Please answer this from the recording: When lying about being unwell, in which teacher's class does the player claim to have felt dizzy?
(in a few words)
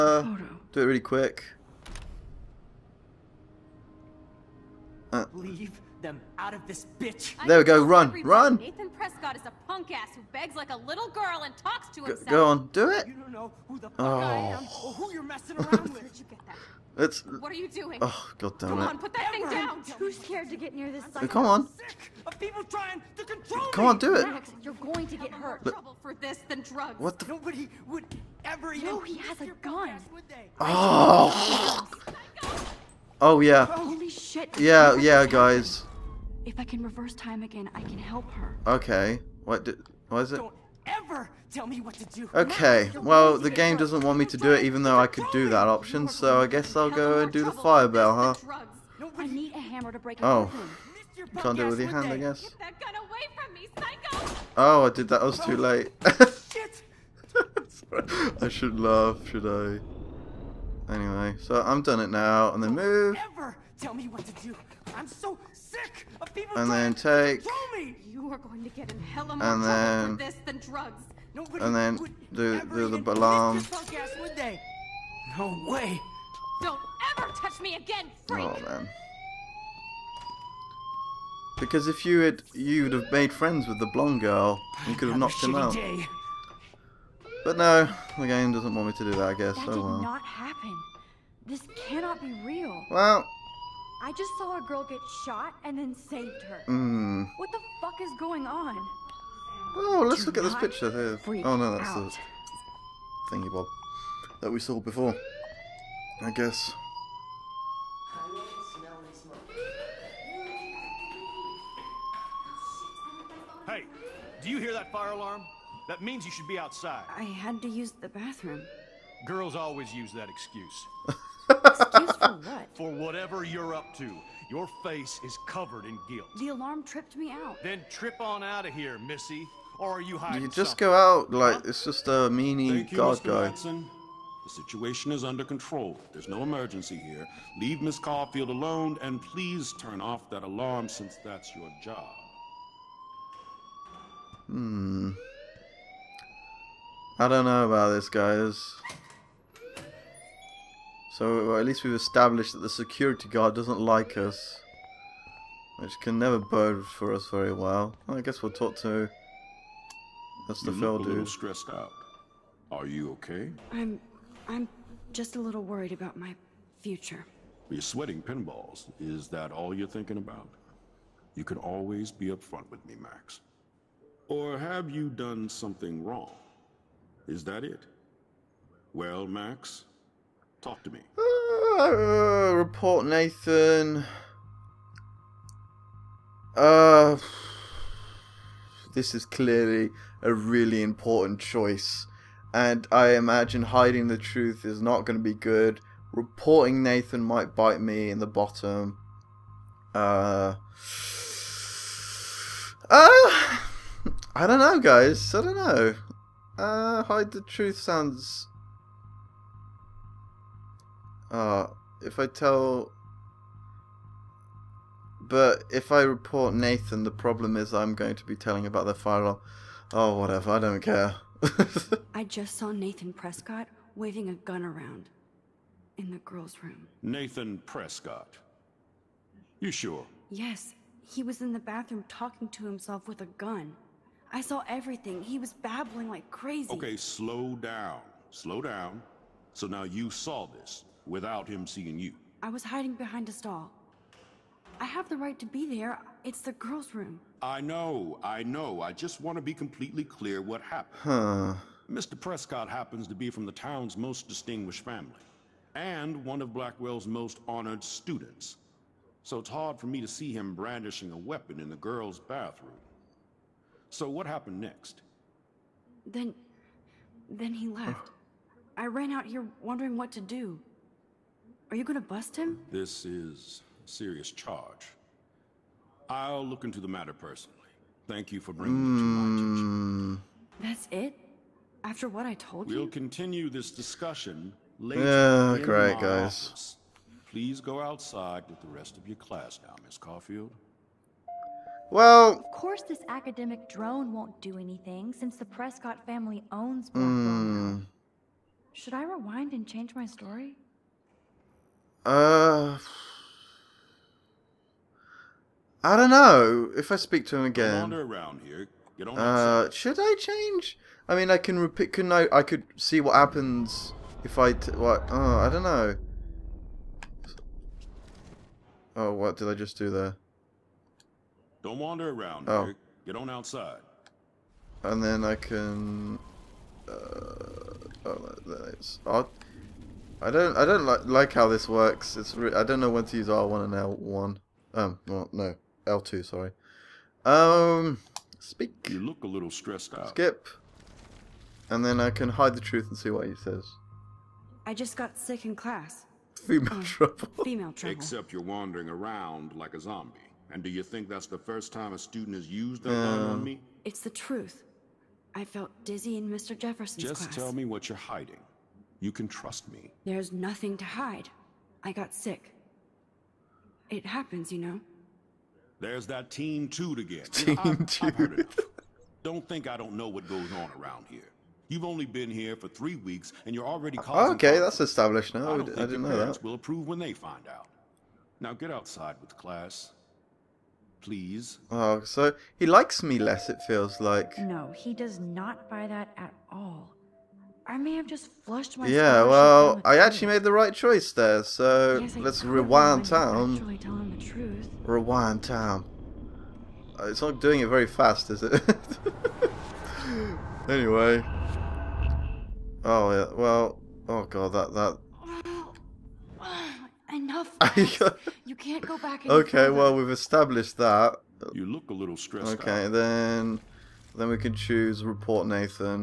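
Mr. Jefferson's.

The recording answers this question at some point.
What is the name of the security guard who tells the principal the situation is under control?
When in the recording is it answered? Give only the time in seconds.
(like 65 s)
133 s.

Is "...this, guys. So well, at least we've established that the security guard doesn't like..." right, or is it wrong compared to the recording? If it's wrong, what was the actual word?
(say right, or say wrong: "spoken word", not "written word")
right.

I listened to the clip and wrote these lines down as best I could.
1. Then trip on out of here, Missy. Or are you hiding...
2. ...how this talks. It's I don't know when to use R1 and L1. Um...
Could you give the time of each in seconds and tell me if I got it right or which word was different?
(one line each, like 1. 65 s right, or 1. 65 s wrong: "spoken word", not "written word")
1. 127 s right
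2. 331 s wrong: "works", not "talks".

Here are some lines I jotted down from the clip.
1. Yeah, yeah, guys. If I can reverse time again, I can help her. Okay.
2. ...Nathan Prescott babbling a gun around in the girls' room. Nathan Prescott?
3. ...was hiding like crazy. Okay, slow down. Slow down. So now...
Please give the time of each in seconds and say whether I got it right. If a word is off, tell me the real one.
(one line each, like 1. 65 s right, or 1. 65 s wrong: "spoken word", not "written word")
1. 34 s right
2. 222 s wrong: "waving", not "babbling"
3. 235 s wrong: "babbling", not "hiding".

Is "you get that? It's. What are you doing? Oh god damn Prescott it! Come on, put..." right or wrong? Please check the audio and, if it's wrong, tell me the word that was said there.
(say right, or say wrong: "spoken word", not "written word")
wrong: "Come", not "Prescott".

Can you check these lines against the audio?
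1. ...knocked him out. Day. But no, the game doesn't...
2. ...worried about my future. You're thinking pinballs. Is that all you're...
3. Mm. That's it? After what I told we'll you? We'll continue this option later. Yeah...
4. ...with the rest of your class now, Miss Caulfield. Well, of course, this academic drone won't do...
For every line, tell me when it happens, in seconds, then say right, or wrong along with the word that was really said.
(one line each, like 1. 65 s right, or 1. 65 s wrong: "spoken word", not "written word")
1. 85 s right
2. 165 s wrong: "sweating", not "thinking"
3. 280 s wrong: "discussion", not "option"
4. 288 s right.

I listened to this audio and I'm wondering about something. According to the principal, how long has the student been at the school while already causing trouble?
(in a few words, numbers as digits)
3 weeks.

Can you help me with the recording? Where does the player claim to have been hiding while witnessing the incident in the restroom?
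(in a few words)
Behind a stall.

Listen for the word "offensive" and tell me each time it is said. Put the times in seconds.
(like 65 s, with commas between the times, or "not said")
not said.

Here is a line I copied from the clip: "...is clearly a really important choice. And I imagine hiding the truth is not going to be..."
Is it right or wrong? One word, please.
right.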